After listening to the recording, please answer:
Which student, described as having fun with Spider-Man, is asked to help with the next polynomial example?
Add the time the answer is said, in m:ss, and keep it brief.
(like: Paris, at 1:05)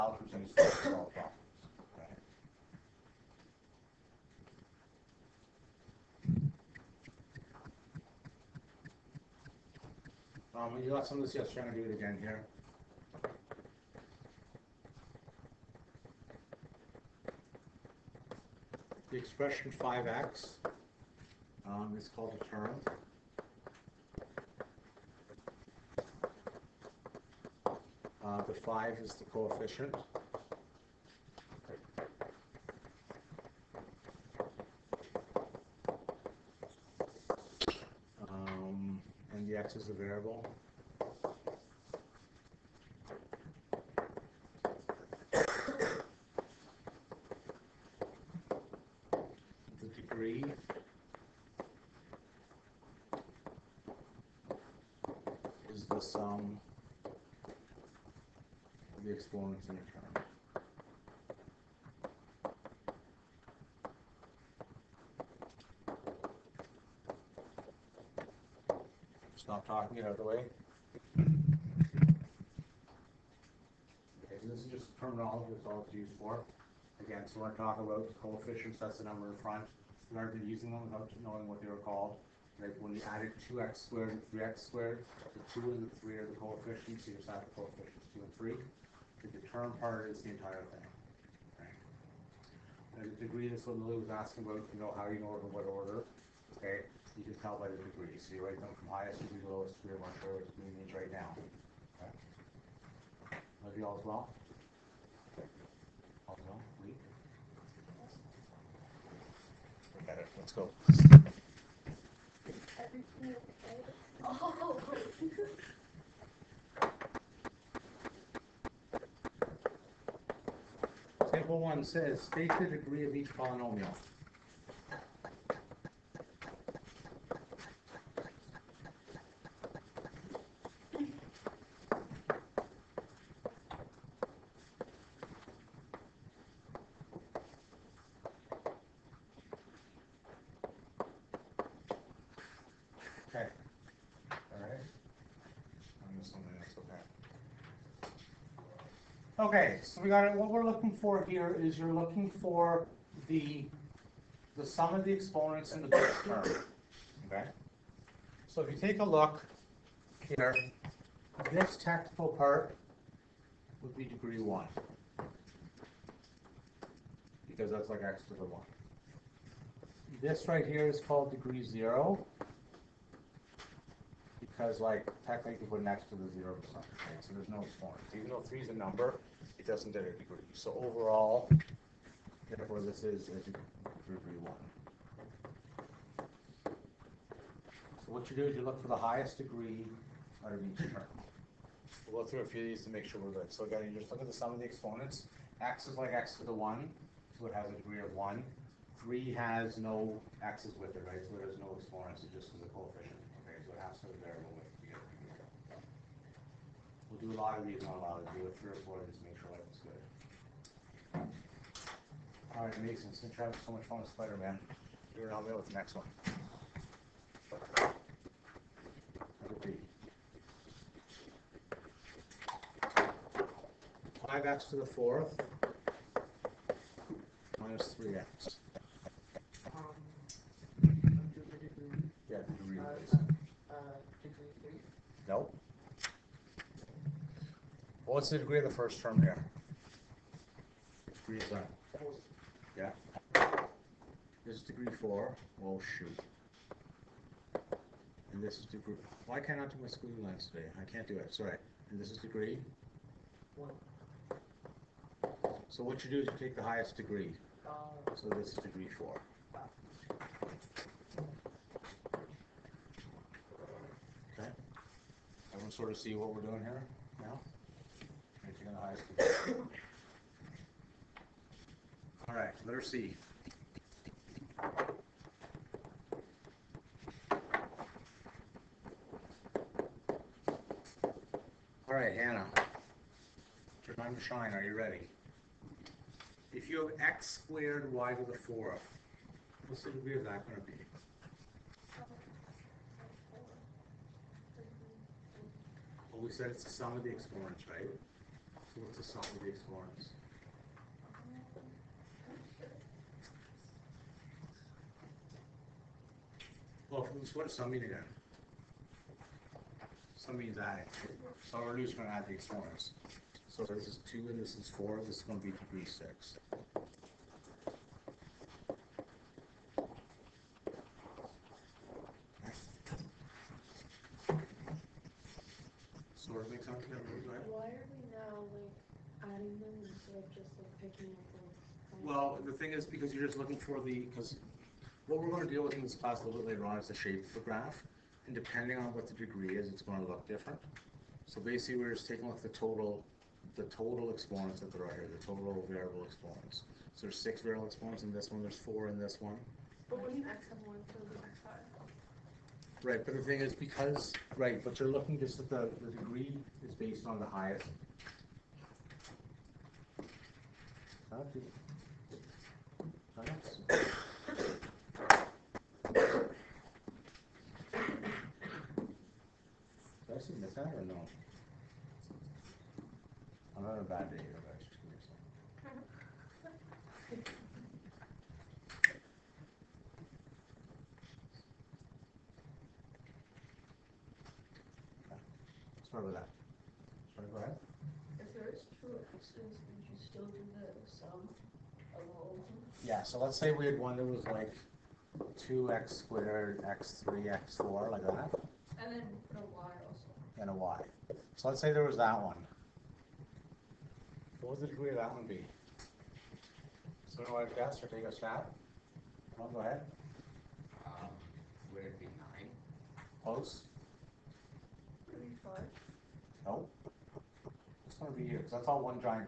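Mason, at 3:32.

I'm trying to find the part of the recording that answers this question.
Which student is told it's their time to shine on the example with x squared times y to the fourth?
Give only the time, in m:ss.
4:42.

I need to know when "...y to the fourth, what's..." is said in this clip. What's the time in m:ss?
4:47.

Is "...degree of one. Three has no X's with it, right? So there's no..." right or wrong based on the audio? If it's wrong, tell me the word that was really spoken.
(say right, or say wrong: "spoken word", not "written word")
right.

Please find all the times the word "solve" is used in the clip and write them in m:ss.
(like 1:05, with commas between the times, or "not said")
0:00, 4:59.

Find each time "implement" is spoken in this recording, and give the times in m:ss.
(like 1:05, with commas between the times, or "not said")
not said.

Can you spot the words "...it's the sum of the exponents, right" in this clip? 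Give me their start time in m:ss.
4:56.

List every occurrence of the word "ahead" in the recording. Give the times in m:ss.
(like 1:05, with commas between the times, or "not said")
6:27, 6:49.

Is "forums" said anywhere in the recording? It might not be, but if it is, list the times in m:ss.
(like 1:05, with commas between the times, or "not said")
4:59, 5:12.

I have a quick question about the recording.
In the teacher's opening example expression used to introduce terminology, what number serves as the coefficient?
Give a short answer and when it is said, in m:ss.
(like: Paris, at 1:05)
5, at 0:28.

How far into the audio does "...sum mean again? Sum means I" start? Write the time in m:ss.
5:07.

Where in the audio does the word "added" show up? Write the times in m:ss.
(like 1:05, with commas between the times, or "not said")
1:23.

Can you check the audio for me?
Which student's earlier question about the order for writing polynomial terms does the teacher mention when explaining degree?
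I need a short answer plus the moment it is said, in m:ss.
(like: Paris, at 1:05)
Lily, at 1:33.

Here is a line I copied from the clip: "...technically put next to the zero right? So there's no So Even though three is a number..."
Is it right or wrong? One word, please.
right.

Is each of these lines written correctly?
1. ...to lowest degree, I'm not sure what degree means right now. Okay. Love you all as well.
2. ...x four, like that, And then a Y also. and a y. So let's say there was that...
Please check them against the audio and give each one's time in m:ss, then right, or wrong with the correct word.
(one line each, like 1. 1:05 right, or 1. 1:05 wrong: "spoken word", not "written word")
1. 1:39 right
2. 6:37 right.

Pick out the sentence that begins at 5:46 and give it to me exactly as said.
So there's six variable exponents in this one, there's four in this one.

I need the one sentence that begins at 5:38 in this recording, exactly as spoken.
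And depending on what the degree is, it's going to look different.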